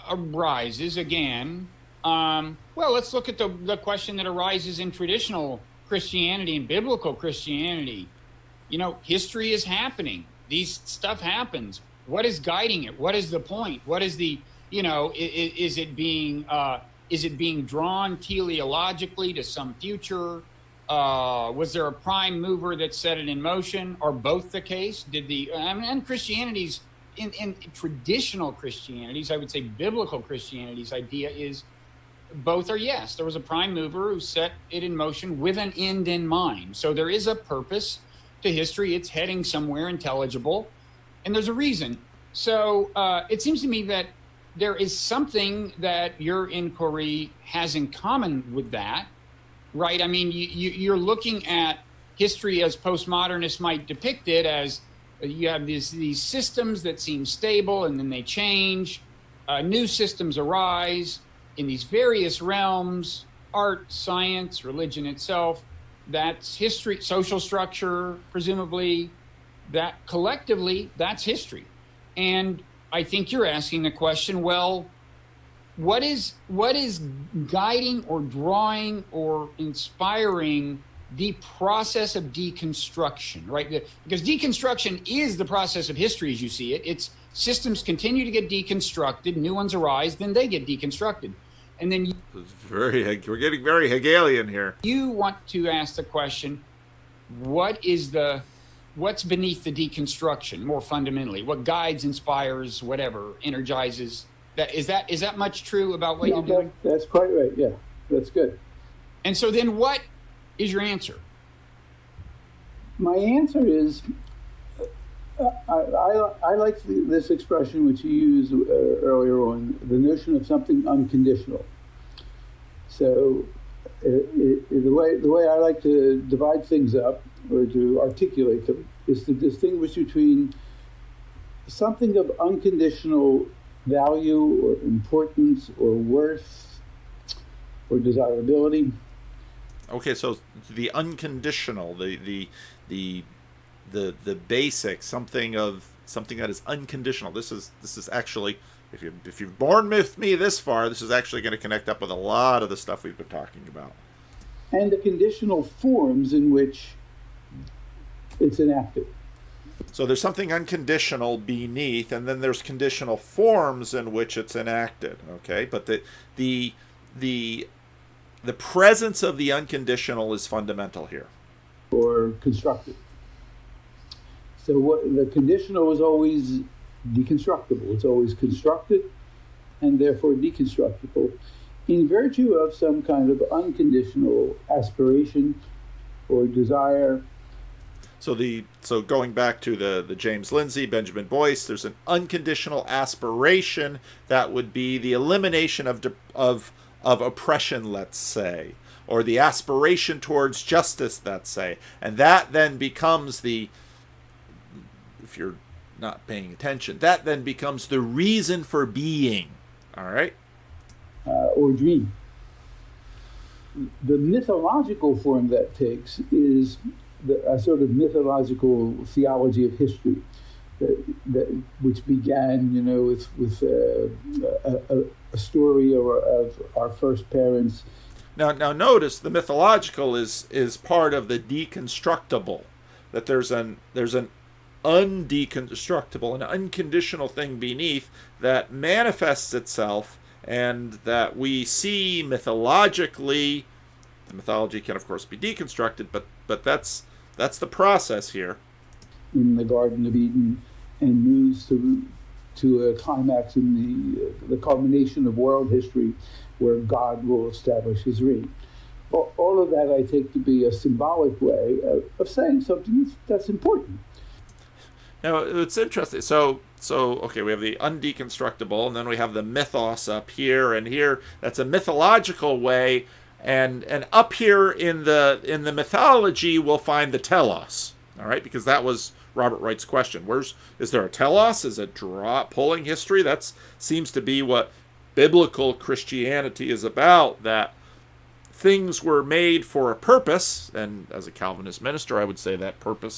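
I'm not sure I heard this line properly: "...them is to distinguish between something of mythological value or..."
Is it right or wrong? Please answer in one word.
wrong.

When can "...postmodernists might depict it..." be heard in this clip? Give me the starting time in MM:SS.
00:52.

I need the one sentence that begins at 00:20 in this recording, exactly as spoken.
Uh, was there a prime mover that set it in motion, or both the case?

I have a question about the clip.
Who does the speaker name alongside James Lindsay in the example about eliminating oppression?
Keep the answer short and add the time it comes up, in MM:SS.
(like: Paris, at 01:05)
Benjamin Boyce, at 03:10.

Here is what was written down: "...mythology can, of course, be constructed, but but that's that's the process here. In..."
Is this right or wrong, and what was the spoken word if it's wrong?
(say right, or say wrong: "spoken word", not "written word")
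wrong: "deconstructed", not "constructed".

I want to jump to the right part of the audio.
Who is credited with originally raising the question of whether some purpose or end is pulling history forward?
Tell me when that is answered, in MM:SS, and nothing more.
04:39.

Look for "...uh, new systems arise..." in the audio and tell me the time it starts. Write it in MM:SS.
00:59.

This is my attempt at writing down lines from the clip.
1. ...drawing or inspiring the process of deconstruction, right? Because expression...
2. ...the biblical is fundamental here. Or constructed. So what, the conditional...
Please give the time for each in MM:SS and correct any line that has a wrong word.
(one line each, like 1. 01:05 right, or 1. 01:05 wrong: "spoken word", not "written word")
1. 01:18 wrong: "deconstruction", not "expression"
2. 02:49 wrong: "unconditional", not "biblical".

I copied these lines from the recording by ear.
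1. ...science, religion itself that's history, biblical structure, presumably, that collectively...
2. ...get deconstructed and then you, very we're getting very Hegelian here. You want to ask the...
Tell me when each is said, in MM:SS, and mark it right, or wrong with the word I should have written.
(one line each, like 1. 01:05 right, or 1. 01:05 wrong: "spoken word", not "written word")
1. 01:03 wrong: "social", not "biblical"
2. 01:30 right.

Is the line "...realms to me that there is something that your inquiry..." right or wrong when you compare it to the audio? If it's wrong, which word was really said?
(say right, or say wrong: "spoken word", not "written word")
wrong: "seems", not "realms".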